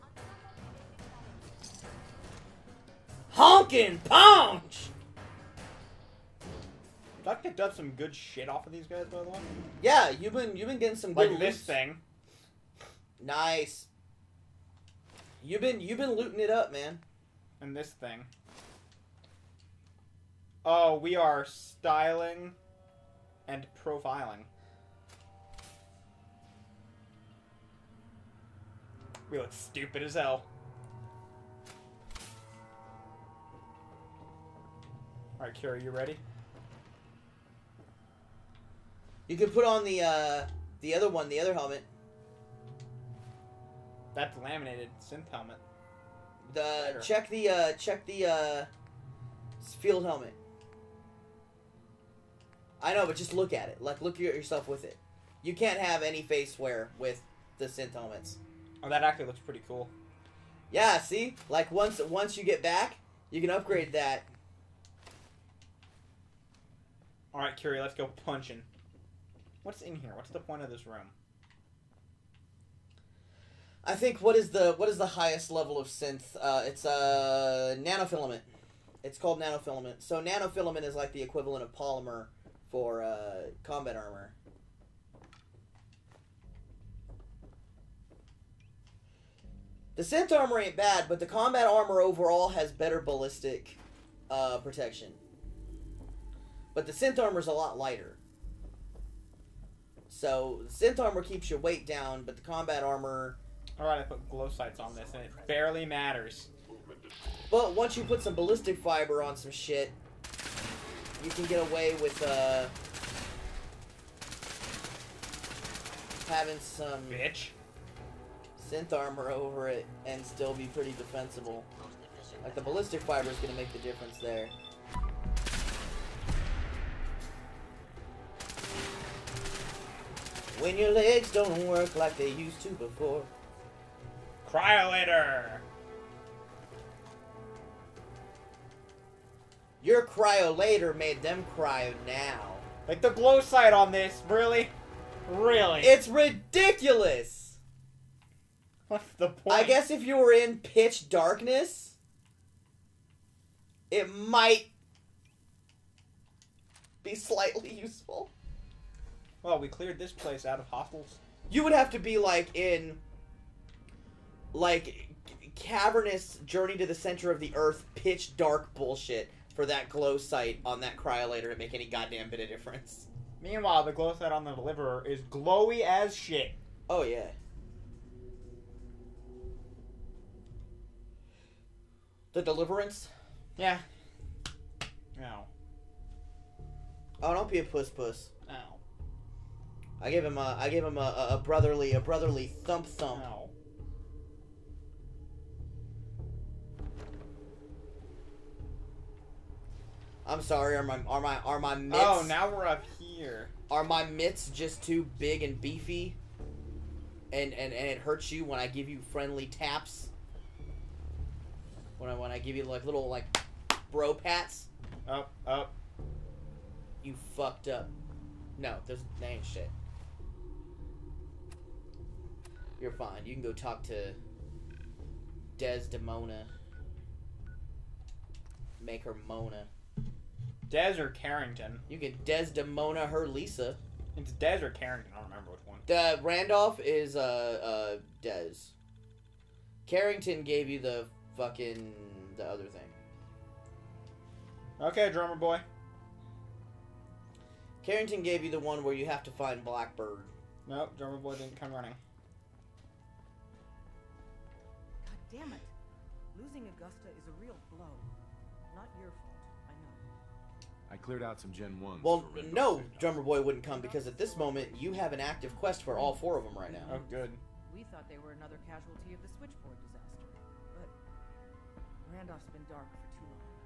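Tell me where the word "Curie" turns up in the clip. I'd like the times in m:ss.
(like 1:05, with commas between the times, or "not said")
0:35, 1:07.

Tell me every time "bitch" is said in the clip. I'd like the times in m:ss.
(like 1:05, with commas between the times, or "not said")
1:57.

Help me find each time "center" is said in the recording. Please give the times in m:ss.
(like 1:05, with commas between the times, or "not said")
2:46.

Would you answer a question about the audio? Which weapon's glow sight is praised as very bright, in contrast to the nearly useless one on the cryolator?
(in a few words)
The Deliverer.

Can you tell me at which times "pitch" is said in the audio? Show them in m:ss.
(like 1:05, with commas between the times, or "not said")
2:30, 2:47.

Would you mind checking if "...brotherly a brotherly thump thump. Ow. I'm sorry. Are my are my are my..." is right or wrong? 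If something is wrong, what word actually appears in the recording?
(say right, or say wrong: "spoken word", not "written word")
right.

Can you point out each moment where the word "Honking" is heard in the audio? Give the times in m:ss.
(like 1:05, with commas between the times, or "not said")
0:03.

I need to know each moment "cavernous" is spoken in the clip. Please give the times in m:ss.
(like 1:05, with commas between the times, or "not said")
2:45.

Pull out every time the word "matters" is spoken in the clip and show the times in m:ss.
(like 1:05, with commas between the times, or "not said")
1:45.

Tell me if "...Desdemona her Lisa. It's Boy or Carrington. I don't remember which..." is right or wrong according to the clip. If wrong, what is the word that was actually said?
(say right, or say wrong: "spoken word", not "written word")
wrong: "Des", not "Boy".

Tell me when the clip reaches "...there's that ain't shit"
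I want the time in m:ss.
3:38.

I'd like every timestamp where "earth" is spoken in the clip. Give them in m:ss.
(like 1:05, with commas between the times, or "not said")
2:47.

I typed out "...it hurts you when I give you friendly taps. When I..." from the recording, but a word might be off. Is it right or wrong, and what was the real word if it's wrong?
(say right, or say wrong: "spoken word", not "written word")
right.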